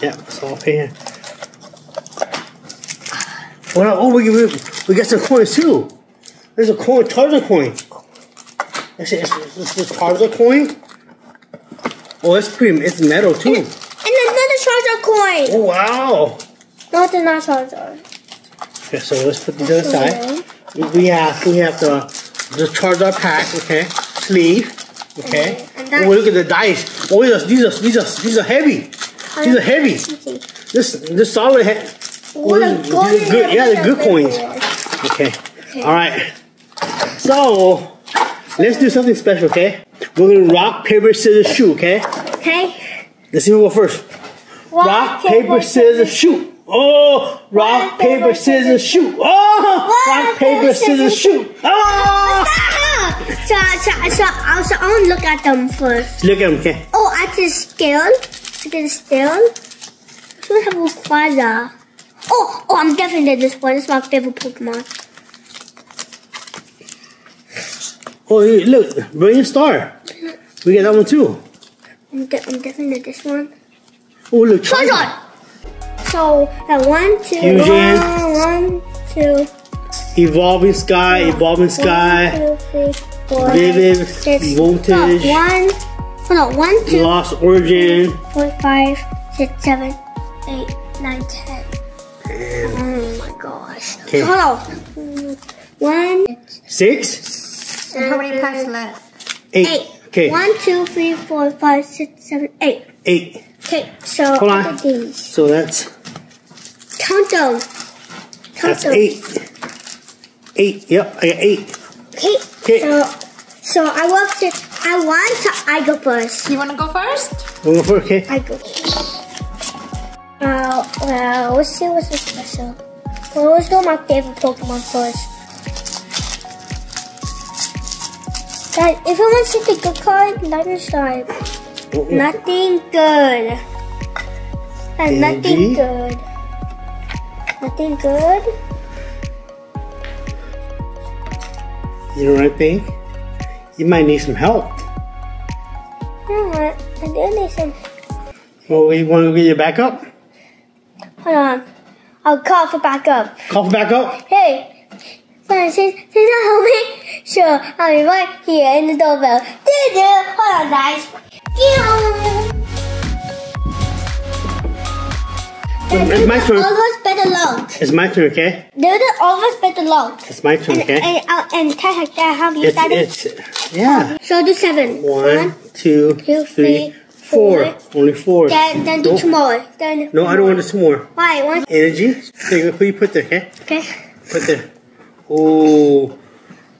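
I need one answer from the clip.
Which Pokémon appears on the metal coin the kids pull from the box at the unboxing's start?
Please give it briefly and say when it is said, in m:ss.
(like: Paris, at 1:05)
Charizard, at 0:07.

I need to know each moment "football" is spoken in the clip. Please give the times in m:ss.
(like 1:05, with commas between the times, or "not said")
not said.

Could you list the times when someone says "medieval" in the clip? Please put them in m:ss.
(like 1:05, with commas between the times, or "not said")
not said.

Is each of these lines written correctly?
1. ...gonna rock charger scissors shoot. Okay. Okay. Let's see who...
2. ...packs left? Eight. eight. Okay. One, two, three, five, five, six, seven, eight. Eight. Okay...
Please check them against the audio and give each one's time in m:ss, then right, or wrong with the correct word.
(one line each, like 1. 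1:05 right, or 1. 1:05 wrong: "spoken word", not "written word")
1. 0:40 wrong: "paper", not "charger"
2. 1:38 wrong: "four", not "five".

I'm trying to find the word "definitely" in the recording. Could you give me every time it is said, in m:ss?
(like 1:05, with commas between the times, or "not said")
1:02, 1:12.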